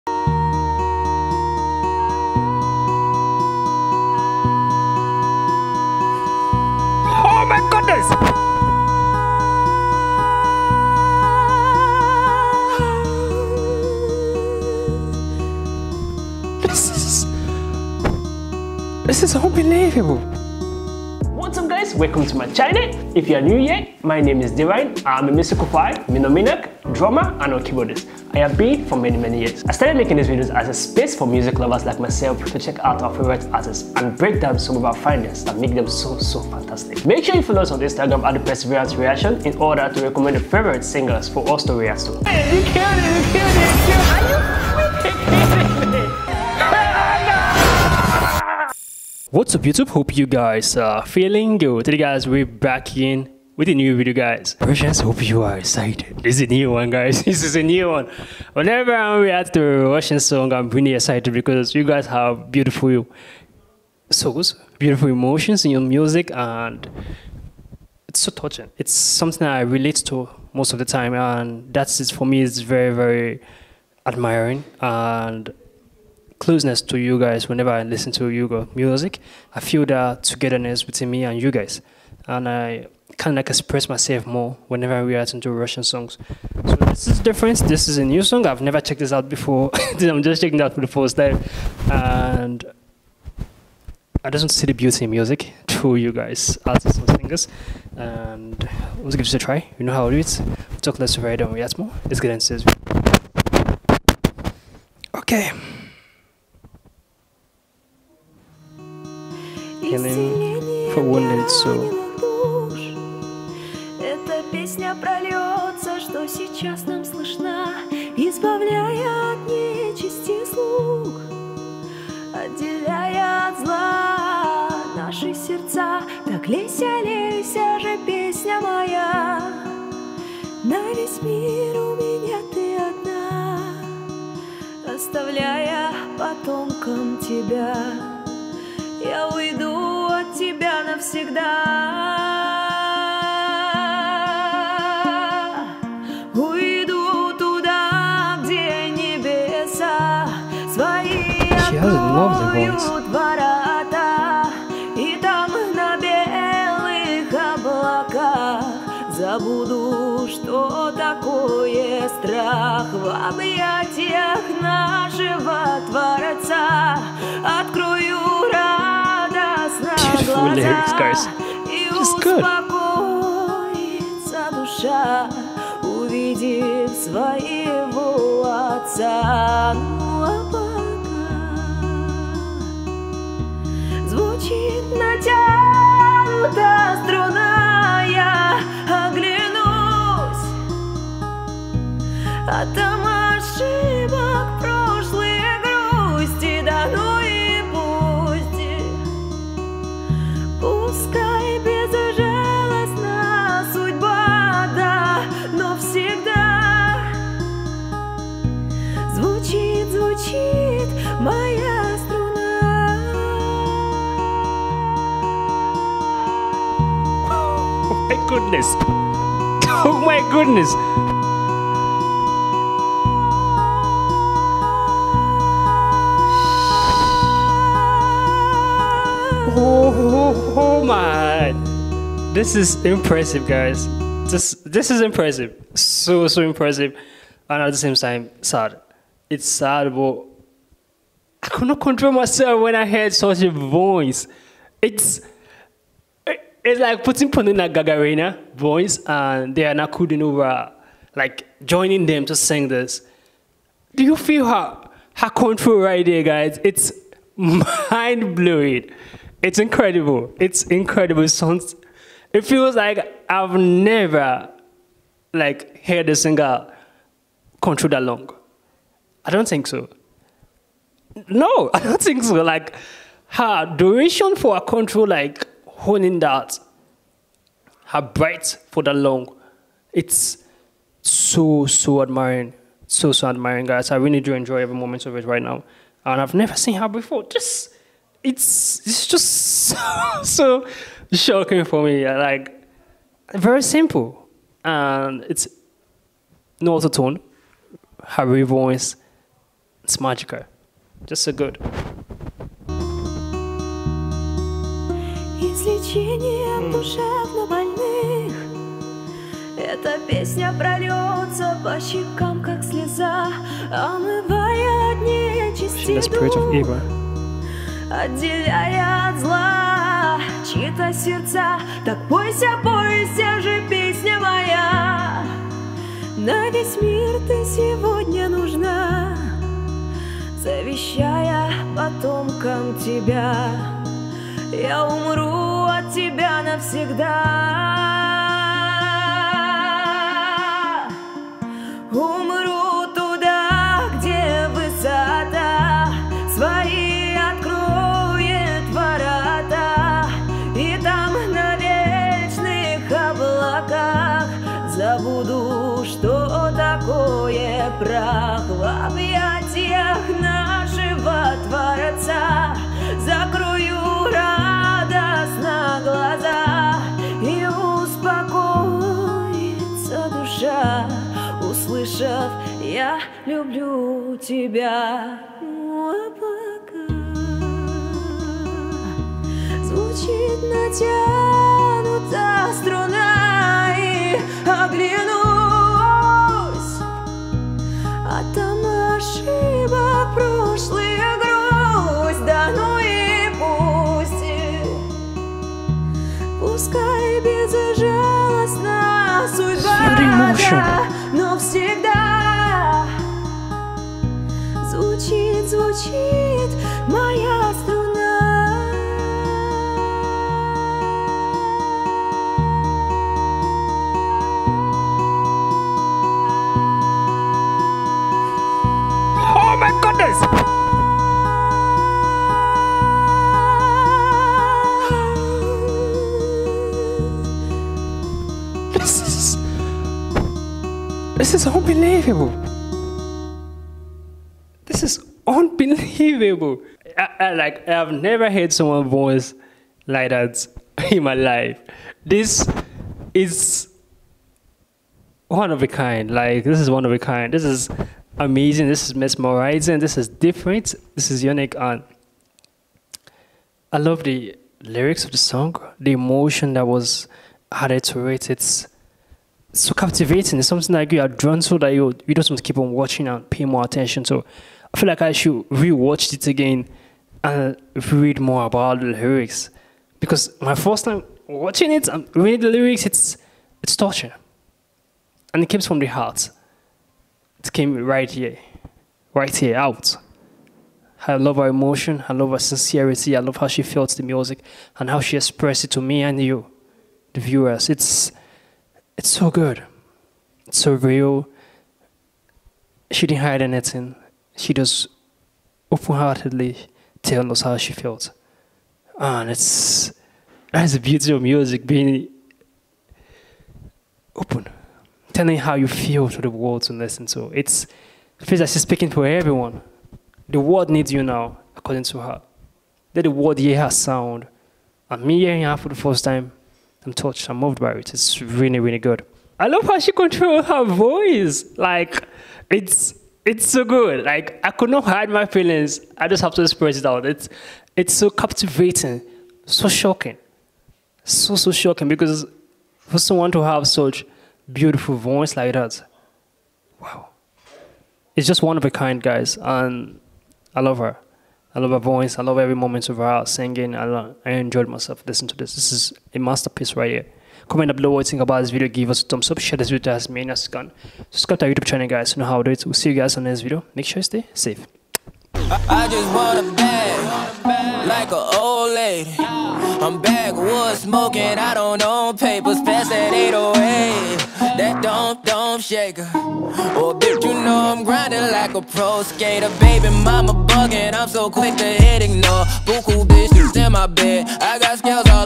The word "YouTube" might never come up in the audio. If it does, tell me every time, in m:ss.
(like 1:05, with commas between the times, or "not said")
0:49, 9:11.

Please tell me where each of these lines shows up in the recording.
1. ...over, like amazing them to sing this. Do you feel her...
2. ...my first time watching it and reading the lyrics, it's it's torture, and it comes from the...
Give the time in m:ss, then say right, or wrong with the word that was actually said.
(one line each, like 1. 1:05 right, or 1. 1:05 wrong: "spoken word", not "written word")
1. 4:10 wrong: "joining", not "amazing"
2. 7:50 right.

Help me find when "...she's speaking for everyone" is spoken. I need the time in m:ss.
8:28.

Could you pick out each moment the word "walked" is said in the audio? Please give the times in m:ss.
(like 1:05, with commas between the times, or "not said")
not said.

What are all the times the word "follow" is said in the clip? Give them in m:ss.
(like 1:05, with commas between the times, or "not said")
0:37.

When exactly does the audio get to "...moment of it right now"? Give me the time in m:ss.
4:44.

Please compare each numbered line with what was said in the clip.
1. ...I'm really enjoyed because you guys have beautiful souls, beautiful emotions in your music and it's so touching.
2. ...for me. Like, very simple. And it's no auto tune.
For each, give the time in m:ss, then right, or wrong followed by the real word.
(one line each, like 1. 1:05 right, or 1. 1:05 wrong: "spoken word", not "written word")
1. 1:00 wrong: "excited", not "enjoyed"
2. 4:51 right.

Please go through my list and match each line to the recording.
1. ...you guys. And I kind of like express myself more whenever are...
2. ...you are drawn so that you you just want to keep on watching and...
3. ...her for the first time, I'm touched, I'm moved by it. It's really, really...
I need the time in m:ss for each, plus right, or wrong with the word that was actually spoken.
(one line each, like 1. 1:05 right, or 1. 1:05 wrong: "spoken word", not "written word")
1. 1:21 right
2. 7:40 right
3. 8:35 right.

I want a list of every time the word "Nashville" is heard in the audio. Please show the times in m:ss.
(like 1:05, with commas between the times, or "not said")
not said.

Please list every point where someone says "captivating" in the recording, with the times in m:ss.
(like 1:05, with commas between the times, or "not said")
7:39, 8:48.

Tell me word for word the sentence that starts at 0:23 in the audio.
If you are new here, my name is Divine.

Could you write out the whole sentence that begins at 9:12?
We'll see you guys on the next video.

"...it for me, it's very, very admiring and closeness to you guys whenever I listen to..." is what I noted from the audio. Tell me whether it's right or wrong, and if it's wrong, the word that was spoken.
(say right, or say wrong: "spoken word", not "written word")
right.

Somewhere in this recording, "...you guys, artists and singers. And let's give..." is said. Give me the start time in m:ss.
1:35.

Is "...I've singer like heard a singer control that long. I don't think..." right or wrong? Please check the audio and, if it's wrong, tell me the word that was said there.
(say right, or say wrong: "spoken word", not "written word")
wrong: "never", not "singer".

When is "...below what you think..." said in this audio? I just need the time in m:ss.
9:07.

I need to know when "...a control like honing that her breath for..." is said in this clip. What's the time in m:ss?
4:34.